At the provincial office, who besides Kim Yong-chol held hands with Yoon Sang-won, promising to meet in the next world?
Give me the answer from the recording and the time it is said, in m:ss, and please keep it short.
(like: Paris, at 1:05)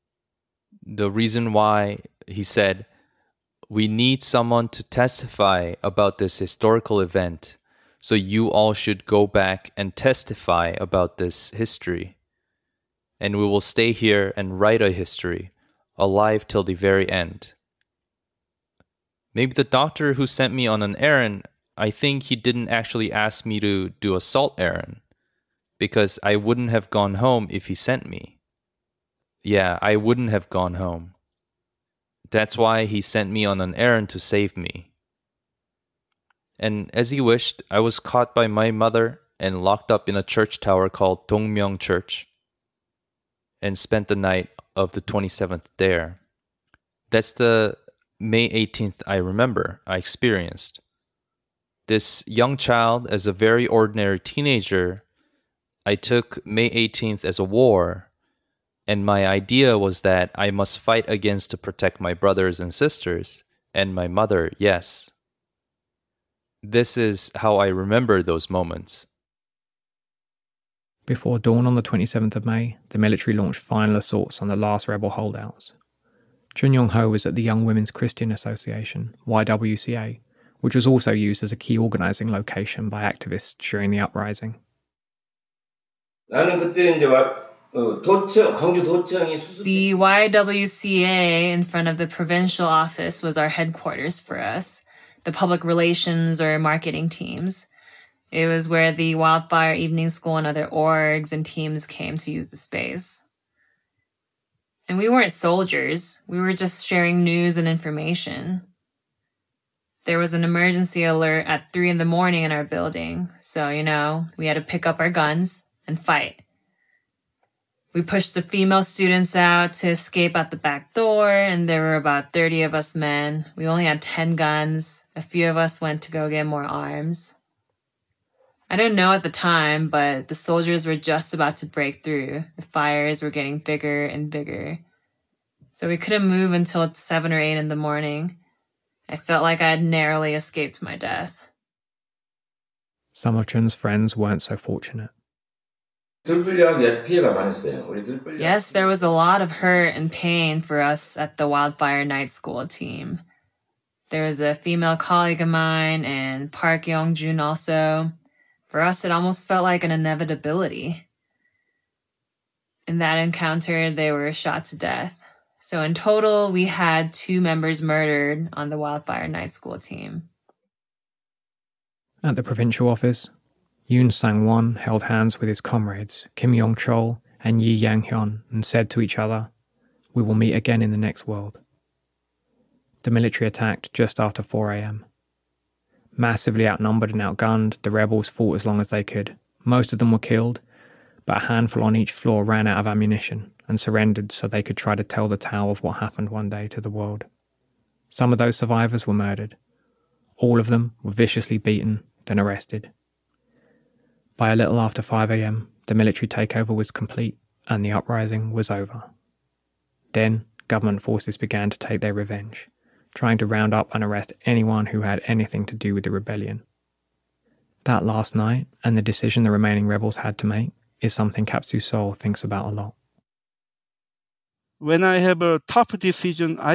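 Yi Yang-hyun, at 2:57.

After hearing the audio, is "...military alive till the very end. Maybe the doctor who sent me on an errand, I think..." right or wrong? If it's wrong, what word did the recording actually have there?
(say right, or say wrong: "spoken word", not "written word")
wrong: "history", not "military".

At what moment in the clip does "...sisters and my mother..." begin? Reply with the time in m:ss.
1:02.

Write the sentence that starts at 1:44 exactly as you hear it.
And we weren't soldiers, we were just sharing news and information.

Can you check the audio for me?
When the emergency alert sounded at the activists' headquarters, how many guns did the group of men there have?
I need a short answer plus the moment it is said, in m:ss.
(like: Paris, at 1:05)
10, at 2:04.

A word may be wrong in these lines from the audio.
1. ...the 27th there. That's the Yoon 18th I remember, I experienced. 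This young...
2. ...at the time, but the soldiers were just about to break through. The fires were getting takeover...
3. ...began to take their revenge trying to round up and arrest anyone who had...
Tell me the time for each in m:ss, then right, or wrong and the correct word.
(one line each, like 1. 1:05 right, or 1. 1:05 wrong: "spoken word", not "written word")
1. 0:44 wrong: "May", not "Yoon"
2. 2:09 wrong: "bigger", not "takeover"
3. 3:31 right.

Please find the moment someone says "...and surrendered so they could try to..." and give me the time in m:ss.
3:13.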